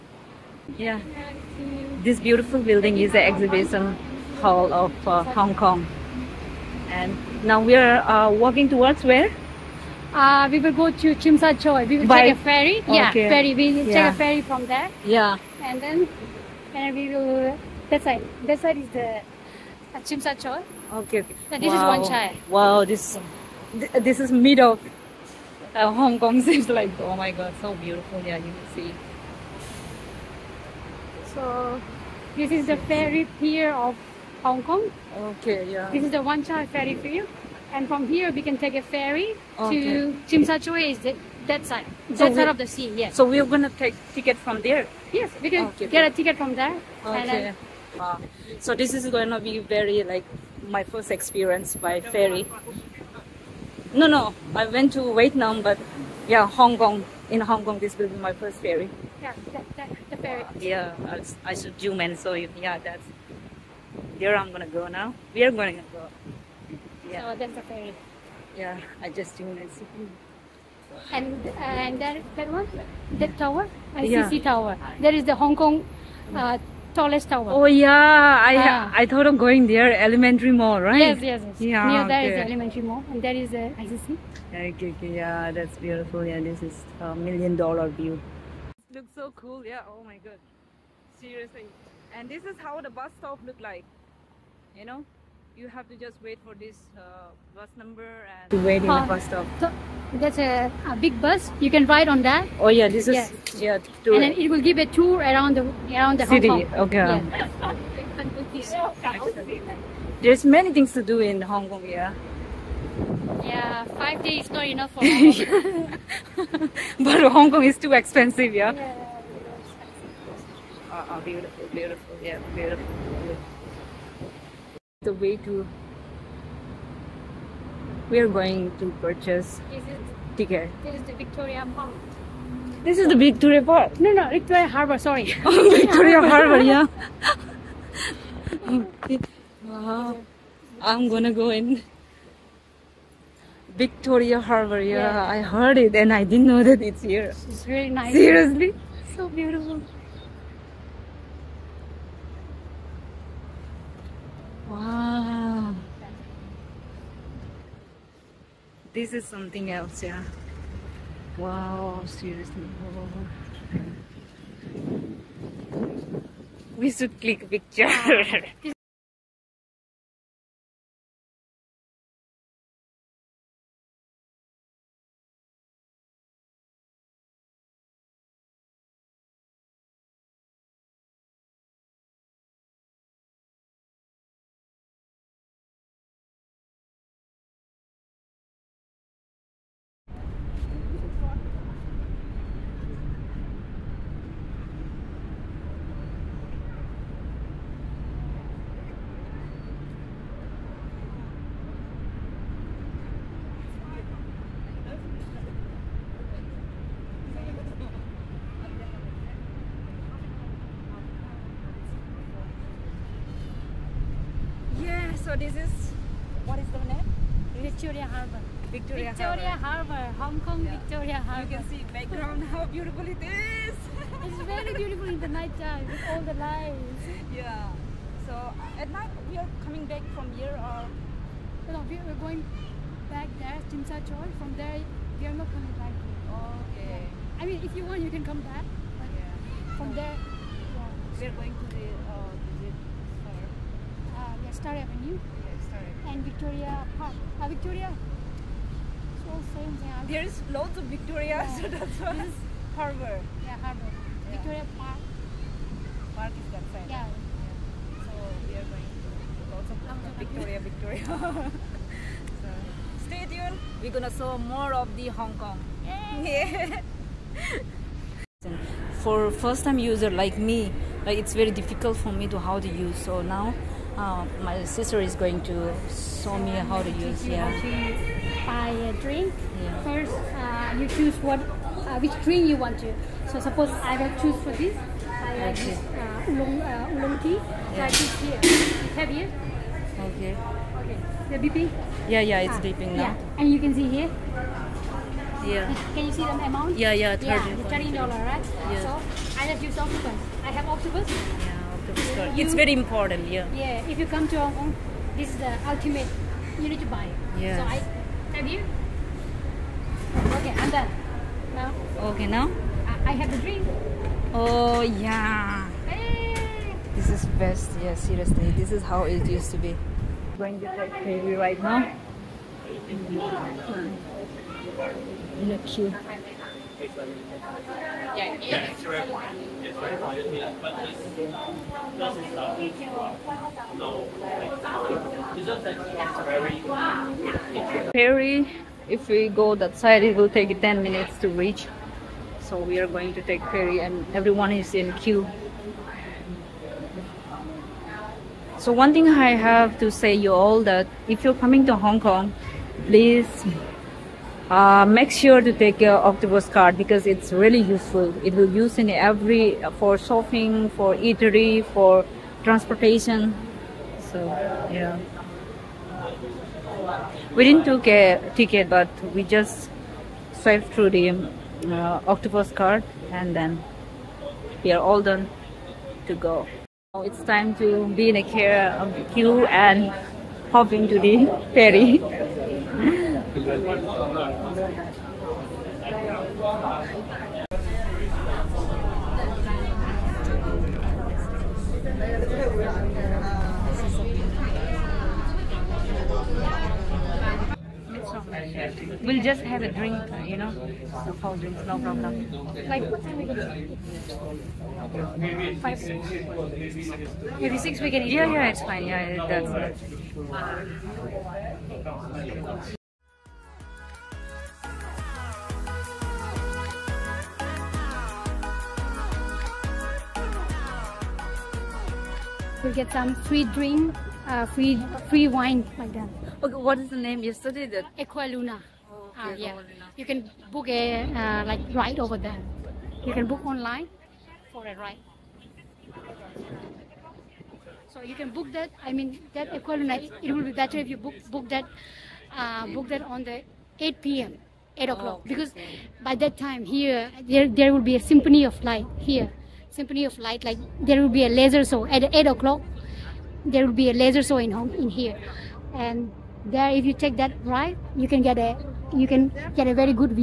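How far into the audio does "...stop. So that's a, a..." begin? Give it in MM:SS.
01:39.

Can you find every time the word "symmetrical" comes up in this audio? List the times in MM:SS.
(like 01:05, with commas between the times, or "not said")
not said.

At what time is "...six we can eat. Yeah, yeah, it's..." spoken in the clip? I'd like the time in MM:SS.
06:47.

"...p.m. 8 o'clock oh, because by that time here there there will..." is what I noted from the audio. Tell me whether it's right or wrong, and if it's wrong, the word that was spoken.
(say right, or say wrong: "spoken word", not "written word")
right.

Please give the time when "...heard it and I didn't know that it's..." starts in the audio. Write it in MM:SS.
02:25.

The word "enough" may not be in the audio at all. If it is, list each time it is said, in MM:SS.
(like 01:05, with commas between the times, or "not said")
01:54.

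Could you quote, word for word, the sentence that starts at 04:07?
Uh, Victoria, it's all same thing.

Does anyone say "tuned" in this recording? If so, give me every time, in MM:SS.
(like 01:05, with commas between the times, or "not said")
01:09, 04:23.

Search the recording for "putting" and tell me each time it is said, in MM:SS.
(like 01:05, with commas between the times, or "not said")
not said.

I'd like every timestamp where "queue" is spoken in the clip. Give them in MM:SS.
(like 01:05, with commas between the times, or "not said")
05:44, 06:19.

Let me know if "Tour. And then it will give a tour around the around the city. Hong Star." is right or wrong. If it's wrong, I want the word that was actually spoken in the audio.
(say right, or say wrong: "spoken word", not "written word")
wrong: "Kong", not "Star".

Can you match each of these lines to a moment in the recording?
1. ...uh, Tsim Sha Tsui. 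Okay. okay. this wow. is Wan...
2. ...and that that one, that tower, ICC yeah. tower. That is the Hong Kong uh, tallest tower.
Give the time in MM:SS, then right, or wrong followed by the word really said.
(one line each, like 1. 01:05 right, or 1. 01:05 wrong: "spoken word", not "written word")
1. 00:19 right
2. 01:11 right.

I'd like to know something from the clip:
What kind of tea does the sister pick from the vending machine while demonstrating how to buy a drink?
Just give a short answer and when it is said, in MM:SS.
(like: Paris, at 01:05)
Oolong tea, at 04:46.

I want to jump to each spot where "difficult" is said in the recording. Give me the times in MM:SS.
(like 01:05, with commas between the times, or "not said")
04:31.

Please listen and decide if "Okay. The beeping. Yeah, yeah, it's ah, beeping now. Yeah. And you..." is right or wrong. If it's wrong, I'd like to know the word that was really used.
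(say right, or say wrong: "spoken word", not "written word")
right.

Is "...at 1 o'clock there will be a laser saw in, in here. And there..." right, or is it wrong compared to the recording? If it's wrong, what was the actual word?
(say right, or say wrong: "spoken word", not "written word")
wrong: "8", not "1".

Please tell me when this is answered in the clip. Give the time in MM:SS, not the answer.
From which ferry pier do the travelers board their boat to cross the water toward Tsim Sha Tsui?
00:36.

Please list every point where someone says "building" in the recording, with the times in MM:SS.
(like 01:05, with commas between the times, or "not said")
00:02.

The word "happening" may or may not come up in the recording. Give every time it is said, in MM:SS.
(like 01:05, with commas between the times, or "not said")
not said.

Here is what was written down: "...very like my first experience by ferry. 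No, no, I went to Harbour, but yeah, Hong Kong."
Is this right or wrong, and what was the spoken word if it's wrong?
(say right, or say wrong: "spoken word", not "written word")
wrong: "Vietnam", not "Harbour".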